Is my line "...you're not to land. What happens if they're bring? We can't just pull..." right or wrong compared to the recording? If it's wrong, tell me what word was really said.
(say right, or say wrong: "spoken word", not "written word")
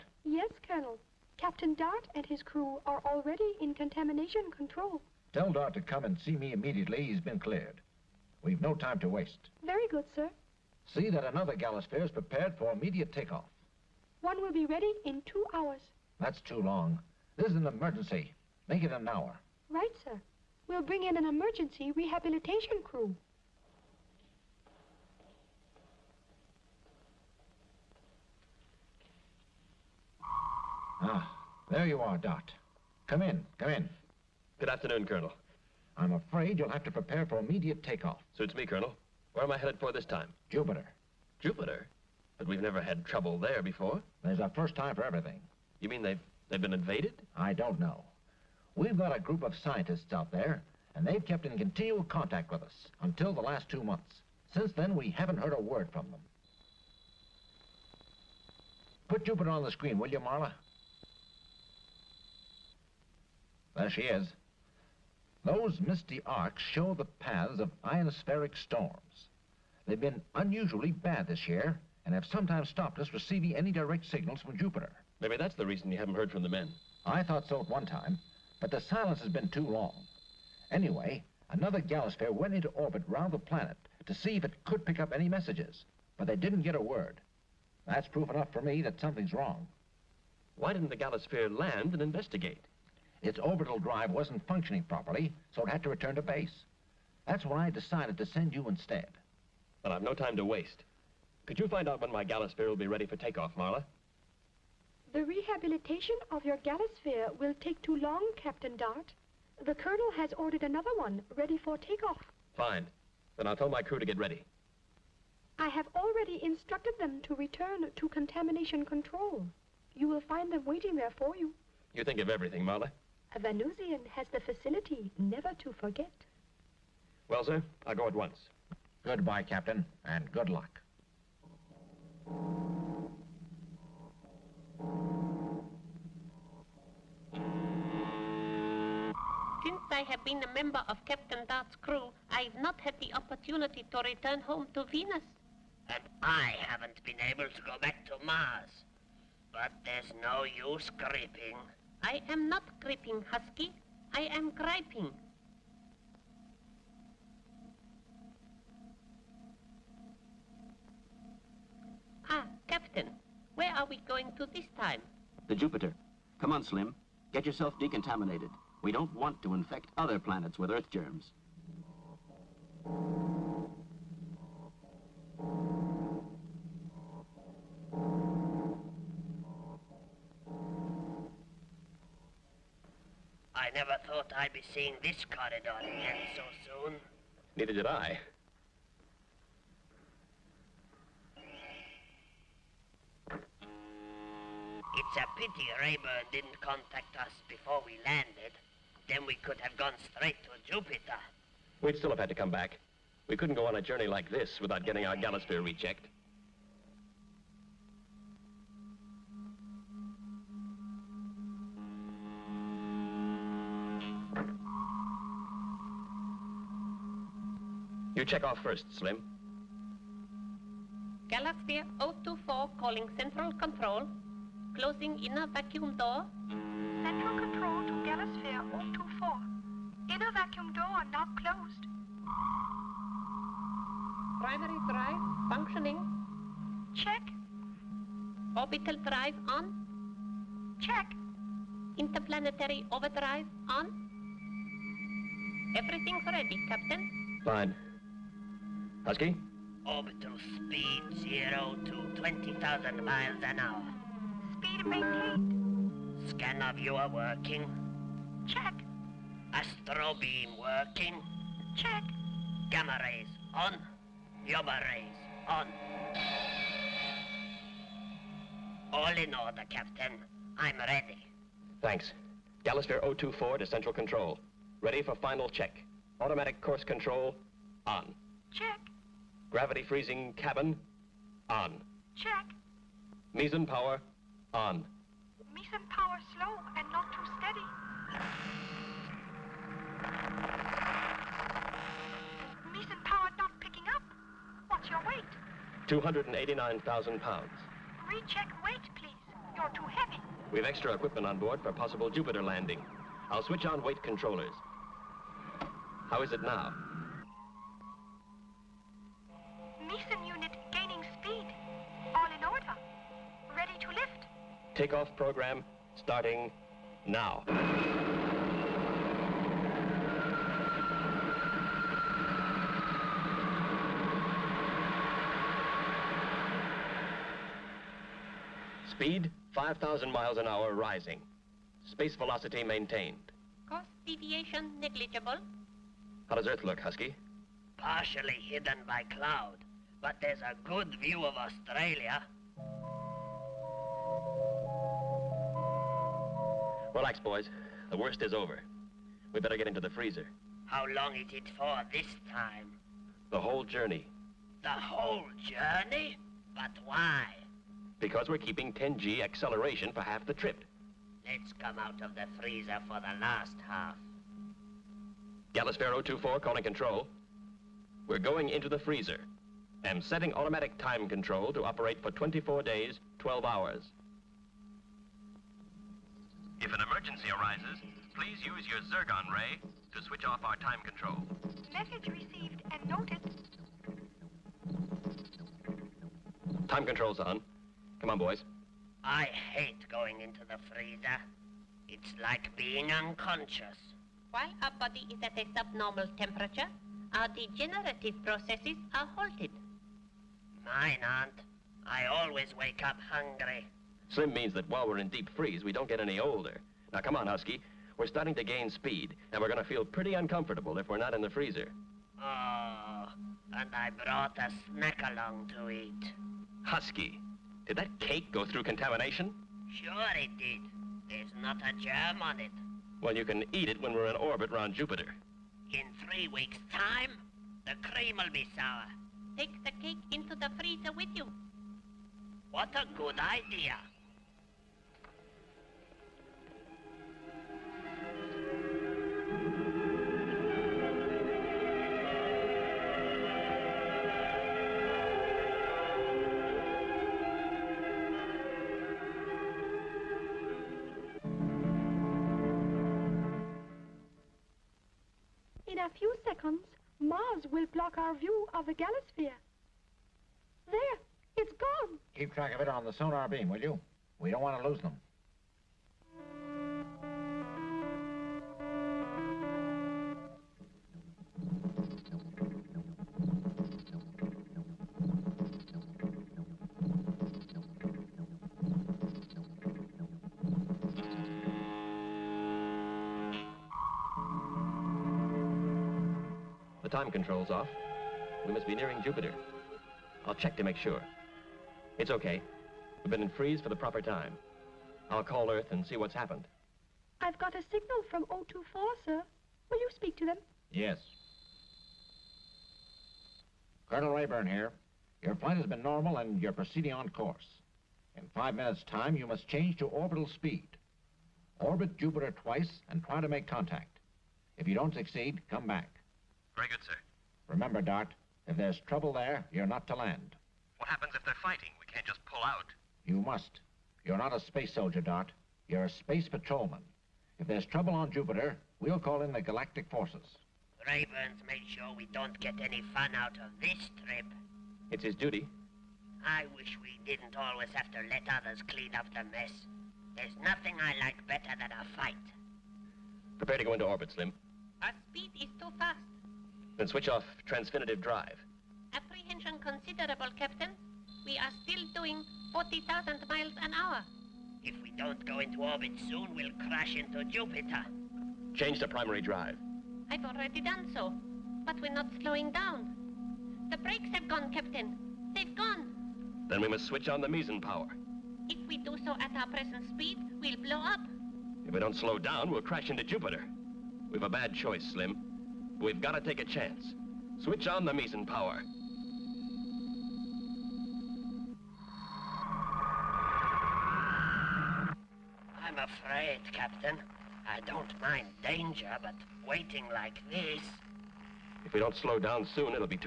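wrong: "fighting", not "bring".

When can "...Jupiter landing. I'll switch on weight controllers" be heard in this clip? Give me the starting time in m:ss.
5:02.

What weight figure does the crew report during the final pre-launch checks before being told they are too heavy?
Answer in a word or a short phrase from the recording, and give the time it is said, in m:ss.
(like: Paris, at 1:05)
289,000 pounds, at 4:55.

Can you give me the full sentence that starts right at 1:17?
I thought so at one time.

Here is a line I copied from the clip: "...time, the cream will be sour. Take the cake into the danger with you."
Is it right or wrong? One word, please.
wrong.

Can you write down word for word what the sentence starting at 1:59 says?
You will find them waiting there for you.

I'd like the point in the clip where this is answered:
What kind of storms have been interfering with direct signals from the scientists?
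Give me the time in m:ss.
1:07.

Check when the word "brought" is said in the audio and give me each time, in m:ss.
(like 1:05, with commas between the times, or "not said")
6:53.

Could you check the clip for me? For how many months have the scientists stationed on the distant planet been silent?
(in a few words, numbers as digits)
2.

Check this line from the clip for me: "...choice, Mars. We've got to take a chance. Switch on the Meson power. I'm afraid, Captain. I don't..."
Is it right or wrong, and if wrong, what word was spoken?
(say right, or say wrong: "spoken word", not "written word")
wrong: "Slim", not "Mars".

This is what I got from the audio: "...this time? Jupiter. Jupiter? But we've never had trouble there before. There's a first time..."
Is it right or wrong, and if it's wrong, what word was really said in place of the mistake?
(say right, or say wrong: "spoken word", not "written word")
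right.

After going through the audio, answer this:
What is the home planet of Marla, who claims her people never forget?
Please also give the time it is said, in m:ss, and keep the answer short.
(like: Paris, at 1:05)
Venus, at 2:24.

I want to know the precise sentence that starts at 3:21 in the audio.
We'd still have had to come back.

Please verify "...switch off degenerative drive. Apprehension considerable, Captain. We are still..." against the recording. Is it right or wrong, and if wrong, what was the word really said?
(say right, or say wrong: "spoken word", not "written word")
wrong: "transfinitive", not "degenerative".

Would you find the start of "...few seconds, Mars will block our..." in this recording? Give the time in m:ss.
7:35.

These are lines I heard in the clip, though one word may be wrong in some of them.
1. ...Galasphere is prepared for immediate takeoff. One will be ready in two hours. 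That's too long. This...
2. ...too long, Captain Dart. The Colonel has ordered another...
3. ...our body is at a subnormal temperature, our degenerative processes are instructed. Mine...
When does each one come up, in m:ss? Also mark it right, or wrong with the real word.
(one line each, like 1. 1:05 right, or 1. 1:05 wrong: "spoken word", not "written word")
1. 0:11 right
2. 1:47 right
3. 6:34 wrong: "halted", not "instructed".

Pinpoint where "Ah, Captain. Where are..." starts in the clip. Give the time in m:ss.
2:42.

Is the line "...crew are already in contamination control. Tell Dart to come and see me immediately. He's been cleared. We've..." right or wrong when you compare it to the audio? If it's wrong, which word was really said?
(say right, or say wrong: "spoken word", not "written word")
right.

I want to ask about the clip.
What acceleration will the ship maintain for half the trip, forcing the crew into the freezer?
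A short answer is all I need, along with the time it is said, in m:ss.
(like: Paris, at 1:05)
10G, at 5:58.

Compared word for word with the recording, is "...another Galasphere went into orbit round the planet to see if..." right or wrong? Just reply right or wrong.
right.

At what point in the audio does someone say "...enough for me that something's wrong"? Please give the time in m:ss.
1:28.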